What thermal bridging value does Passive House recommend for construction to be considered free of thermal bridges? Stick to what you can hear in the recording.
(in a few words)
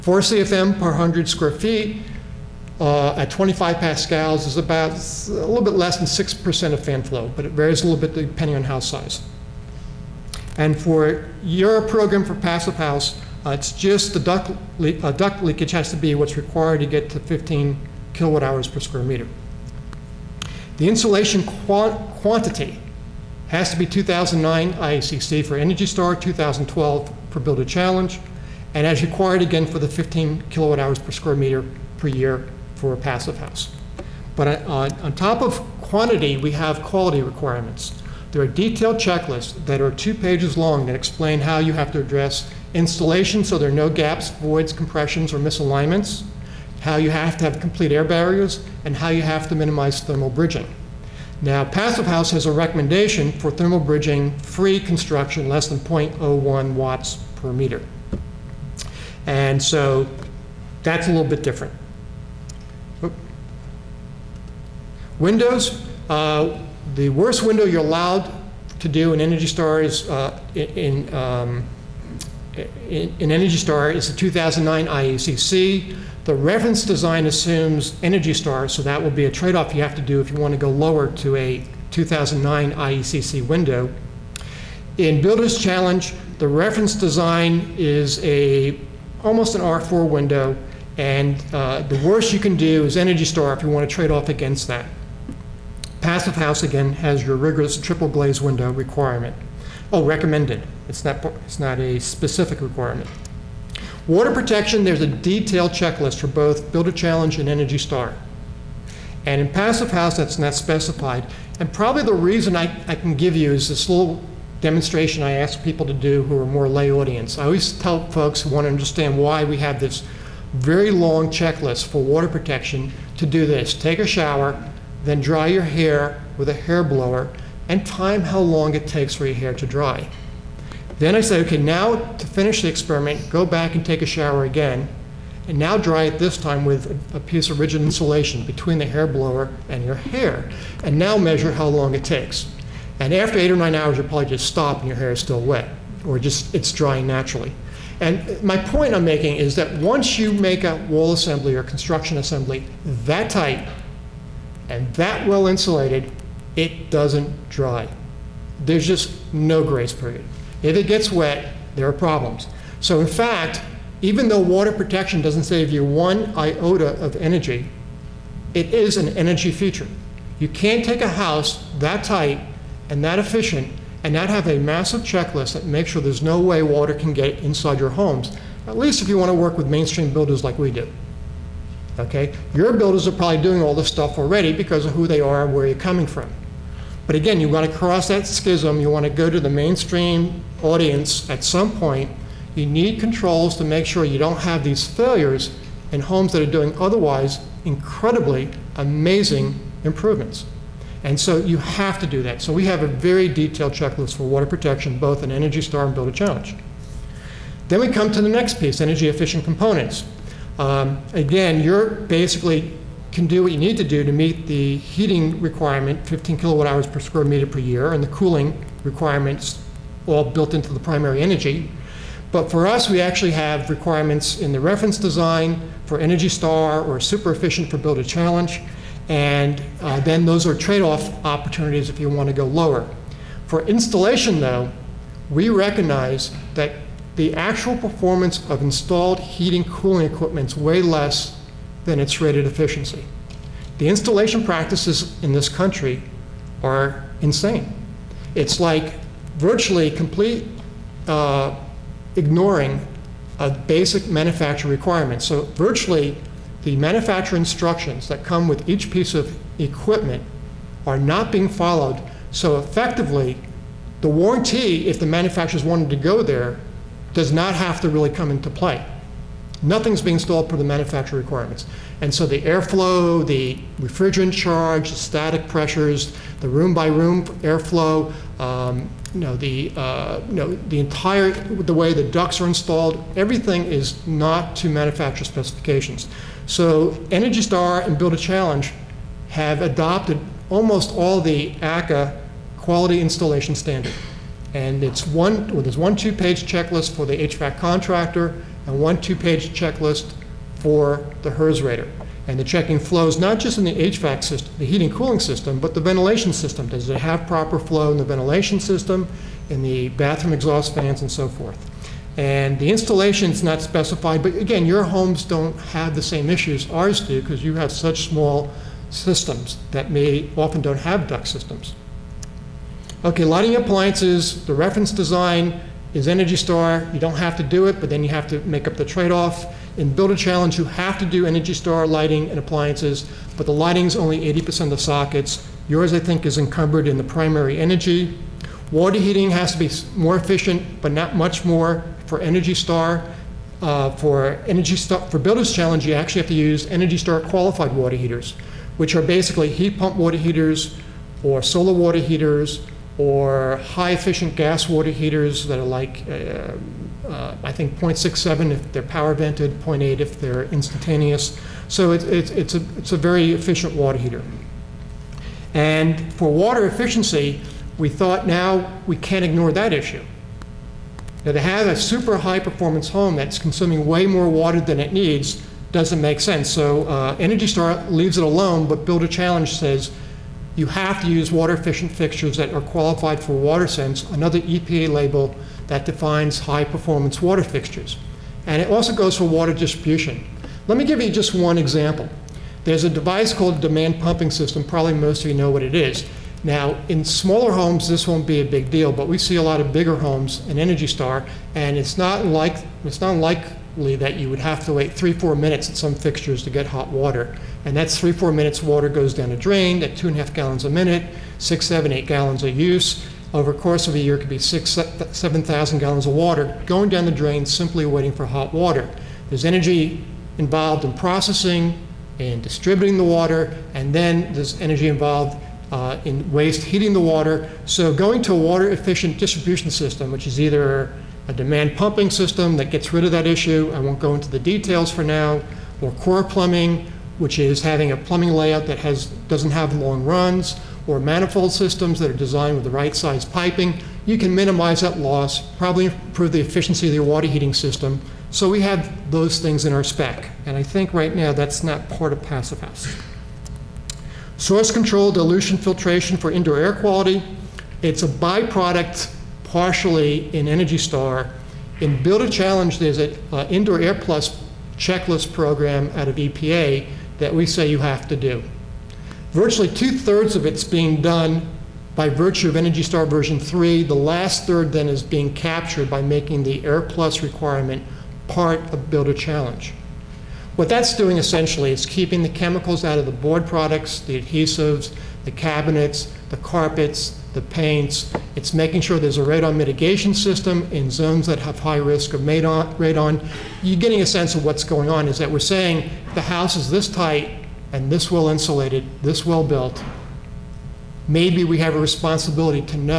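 less than 0.01 watts per meter.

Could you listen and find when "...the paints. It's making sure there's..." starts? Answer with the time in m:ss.
8:07.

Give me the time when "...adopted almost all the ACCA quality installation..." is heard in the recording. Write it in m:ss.
4:49.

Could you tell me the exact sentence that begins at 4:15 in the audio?
So virtually the manufacturer instructions that come with each piece of equipment are not being followed.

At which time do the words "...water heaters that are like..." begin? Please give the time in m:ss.
5:54.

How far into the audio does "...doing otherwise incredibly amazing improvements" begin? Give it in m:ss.
3:16.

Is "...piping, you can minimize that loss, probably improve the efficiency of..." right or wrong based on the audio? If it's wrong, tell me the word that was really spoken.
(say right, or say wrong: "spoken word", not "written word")
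right.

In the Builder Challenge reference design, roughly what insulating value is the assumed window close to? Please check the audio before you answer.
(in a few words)
R4.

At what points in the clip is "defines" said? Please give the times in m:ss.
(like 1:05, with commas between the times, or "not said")
6:25.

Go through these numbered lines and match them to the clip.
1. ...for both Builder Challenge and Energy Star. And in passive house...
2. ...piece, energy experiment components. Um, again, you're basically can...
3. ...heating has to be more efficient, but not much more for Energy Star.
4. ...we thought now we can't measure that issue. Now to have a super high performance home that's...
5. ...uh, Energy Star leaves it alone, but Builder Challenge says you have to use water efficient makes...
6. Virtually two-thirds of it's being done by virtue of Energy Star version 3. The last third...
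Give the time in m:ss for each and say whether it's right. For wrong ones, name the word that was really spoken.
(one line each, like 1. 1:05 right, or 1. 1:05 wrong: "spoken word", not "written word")
1. 1:46 right
2. 3:28 wrong: "efficient", not "experiment"
3. 5:38 right
4. 6:07 wrong: "ignore", not "measure"
5. 6:16 wrong: "fixtures", not "makes"
6. 7:49 right.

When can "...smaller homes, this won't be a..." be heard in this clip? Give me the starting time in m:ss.
6:37.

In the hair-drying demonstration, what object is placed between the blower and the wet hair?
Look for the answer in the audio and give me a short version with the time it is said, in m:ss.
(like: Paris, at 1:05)
rigid insulation, at 2:17.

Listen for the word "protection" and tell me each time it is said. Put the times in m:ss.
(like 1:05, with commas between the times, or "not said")
1:44, 2:02, 2:44, 3:24.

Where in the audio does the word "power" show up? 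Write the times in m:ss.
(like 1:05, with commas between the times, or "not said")
5:58.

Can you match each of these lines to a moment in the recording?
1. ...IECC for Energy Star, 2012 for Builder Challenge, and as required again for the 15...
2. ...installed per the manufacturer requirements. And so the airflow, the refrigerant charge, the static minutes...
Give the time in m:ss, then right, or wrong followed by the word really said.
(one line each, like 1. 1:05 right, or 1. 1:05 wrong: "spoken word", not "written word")
1. 0:24 right
2. 4:30 wrong: "pressures", not "minutes".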